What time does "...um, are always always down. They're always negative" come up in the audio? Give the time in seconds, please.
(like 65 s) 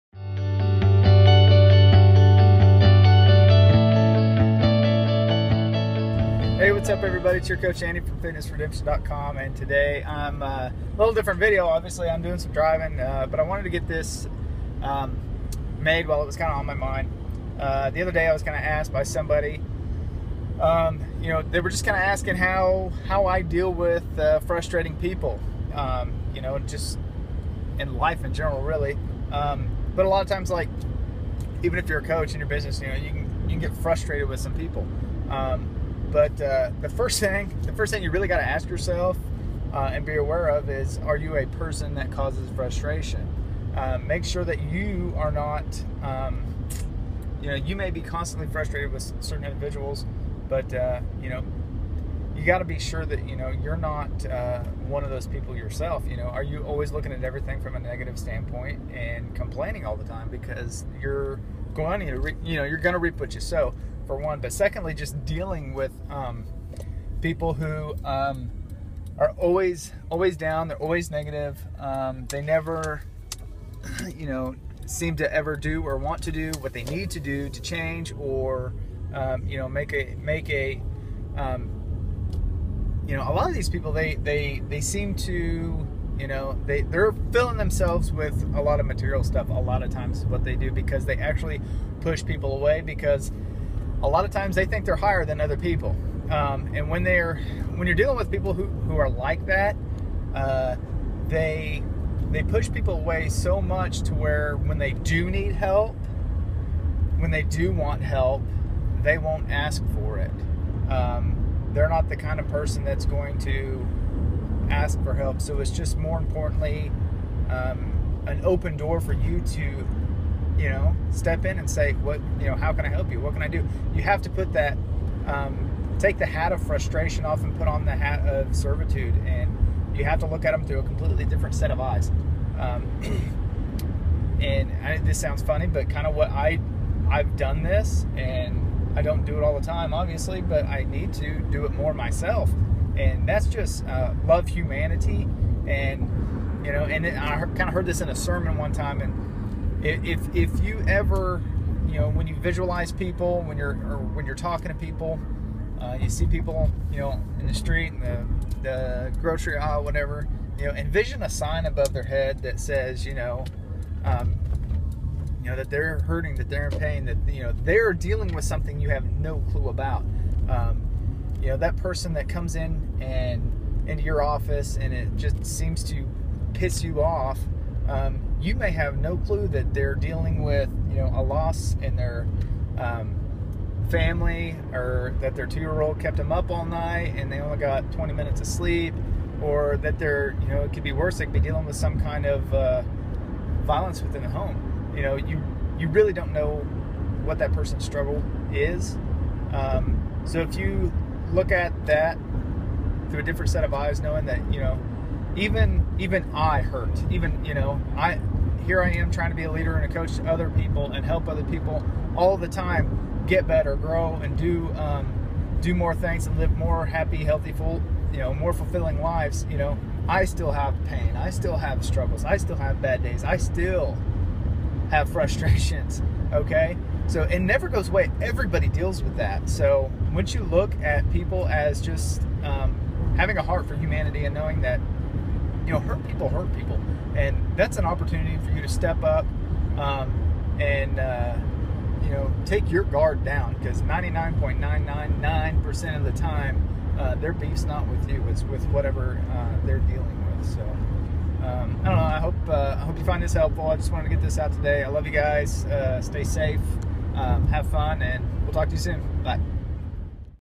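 68 s.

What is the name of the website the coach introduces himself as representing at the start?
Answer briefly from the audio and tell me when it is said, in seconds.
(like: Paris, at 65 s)
FitnessRedemption.com, at 8 s.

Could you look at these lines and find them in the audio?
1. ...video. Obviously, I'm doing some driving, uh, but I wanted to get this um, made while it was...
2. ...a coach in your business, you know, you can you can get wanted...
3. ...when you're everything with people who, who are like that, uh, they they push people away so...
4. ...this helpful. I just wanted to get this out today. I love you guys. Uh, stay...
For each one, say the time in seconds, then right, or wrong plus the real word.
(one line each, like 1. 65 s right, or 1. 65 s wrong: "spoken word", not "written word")
1. 11 s right
2. 31 s wrong: "frustrated", not "wanted"
3. 97 s wrong: "dealing", not "everything"
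4. 253 s right.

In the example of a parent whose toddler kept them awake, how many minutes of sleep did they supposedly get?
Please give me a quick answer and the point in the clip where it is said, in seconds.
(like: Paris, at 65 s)
20, at 187 s.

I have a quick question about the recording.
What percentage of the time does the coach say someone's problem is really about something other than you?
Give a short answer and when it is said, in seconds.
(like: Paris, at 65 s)
99.999%, at 243 s.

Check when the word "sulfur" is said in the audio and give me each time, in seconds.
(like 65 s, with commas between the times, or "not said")
not said.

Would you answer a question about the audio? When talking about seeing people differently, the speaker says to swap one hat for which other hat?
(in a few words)
The hat of servitude.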